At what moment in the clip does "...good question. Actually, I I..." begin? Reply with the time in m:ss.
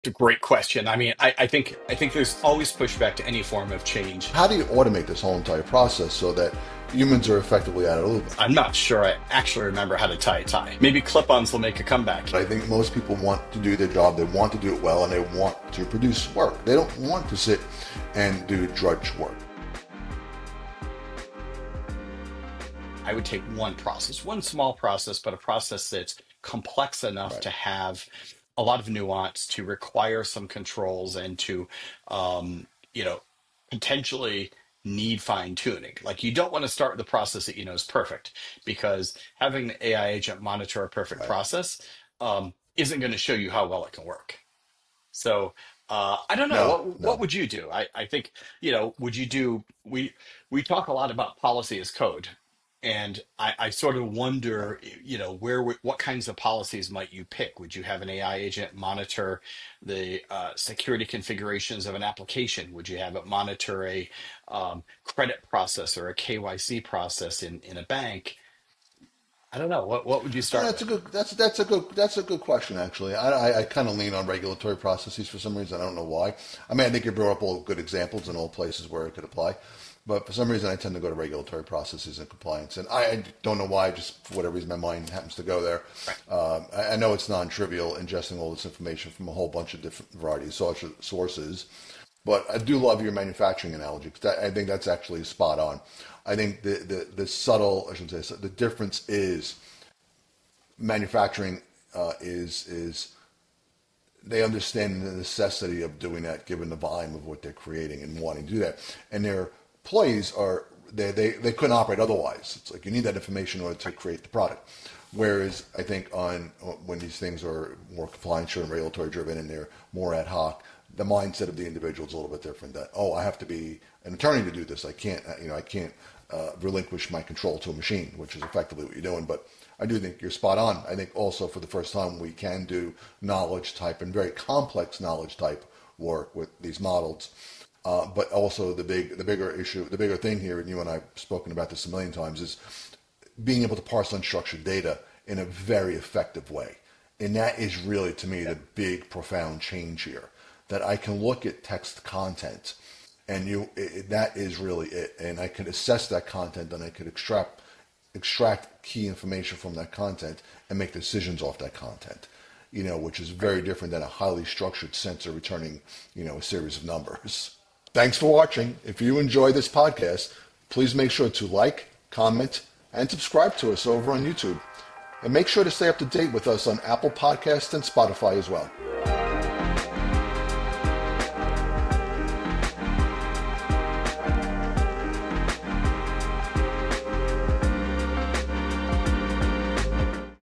1:12.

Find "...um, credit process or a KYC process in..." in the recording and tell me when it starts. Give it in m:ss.
1:04.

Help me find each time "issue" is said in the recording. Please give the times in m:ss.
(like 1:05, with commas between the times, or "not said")
2:19.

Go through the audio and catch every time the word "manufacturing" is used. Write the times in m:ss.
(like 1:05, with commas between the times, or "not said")
1:33, 1:40.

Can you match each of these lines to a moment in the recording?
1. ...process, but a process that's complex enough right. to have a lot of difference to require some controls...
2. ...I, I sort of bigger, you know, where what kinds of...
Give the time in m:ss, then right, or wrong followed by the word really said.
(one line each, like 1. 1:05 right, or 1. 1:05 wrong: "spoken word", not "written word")
1. 0:24 wrong: "nuance", not "difference"
2. 0:53 wrong: "wonder", not "bigger".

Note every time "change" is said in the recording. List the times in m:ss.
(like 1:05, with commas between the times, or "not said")
0:03, 2:29.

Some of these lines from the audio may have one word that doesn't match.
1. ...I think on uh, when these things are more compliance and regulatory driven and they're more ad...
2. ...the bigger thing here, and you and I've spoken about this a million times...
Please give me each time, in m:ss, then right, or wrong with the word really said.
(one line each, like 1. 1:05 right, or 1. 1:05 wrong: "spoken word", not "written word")
1. 1:55 right
2. 2:19 right.